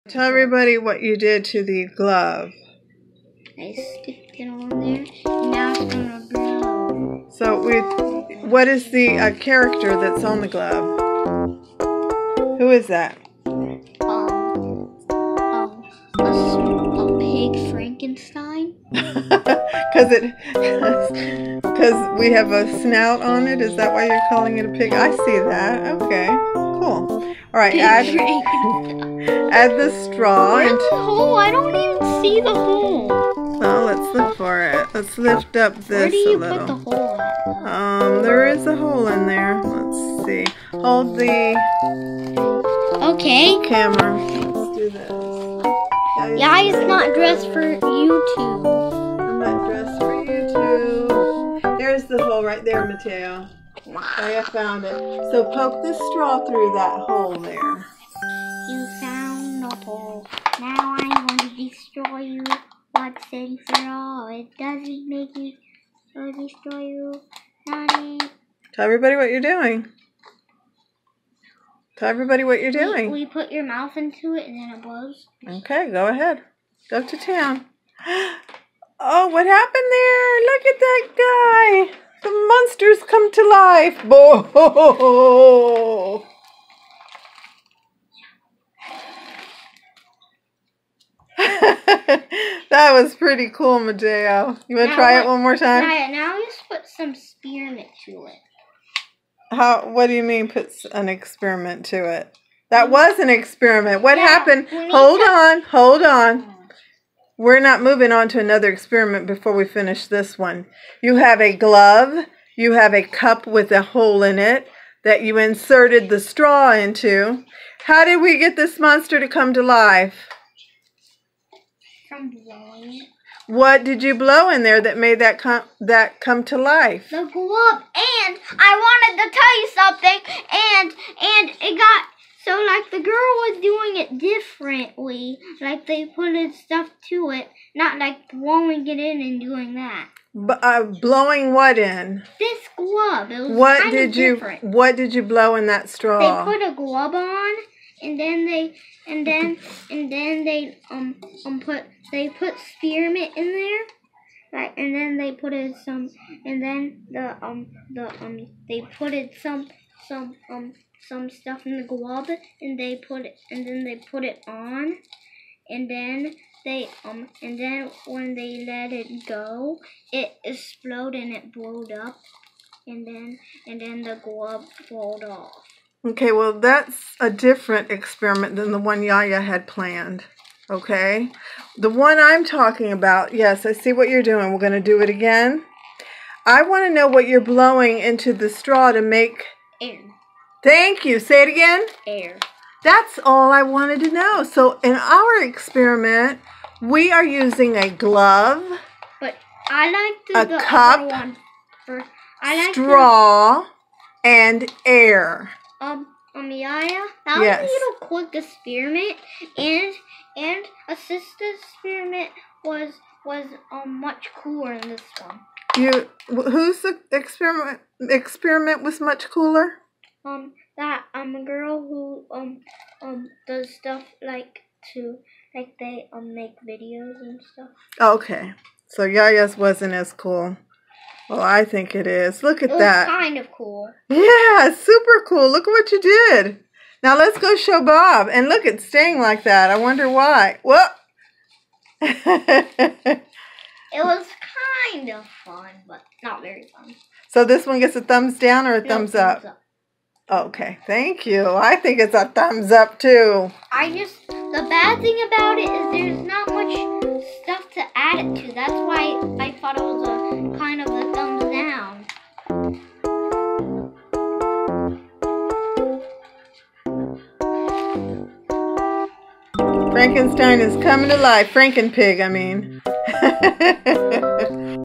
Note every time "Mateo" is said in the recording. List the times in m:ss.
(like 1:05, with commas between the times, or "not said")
0:52, 1:33.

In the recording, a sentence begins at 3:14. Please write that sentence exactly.
So in our experiment, we are using a glove.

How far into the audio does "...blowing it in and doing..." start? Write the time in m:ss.
2:18.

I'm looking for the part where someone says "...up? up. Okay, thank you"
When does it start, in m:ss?
4:09.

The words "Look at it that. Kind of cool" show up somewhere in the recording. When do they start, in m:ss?
3:52.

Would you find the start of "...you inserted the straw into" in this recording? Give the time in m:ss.
1:55.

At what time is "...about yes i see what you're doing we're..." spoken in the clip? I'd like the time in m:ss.
3:02.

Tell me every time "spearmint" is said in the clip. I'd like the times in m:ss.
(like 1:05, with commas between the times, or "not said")
1:37, 2:32.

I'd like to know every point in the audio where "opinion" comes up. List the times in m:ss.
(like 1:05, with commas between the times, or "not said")
not said.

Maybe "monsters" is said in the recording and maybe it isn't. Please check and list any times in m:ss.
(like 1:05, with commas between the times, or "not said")
1:22, 1:58.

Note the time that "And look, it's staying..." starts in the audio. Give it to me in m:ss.
3:58.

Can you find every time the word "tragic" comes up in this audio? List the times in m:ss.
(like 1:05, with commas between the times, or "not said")
not said.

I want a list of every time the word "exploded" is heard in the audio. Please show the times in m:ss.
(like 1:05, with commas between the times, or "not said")
2:50.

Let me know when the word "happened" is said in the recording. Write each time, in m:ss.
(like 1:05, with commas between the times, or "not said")
1:19, 1:44.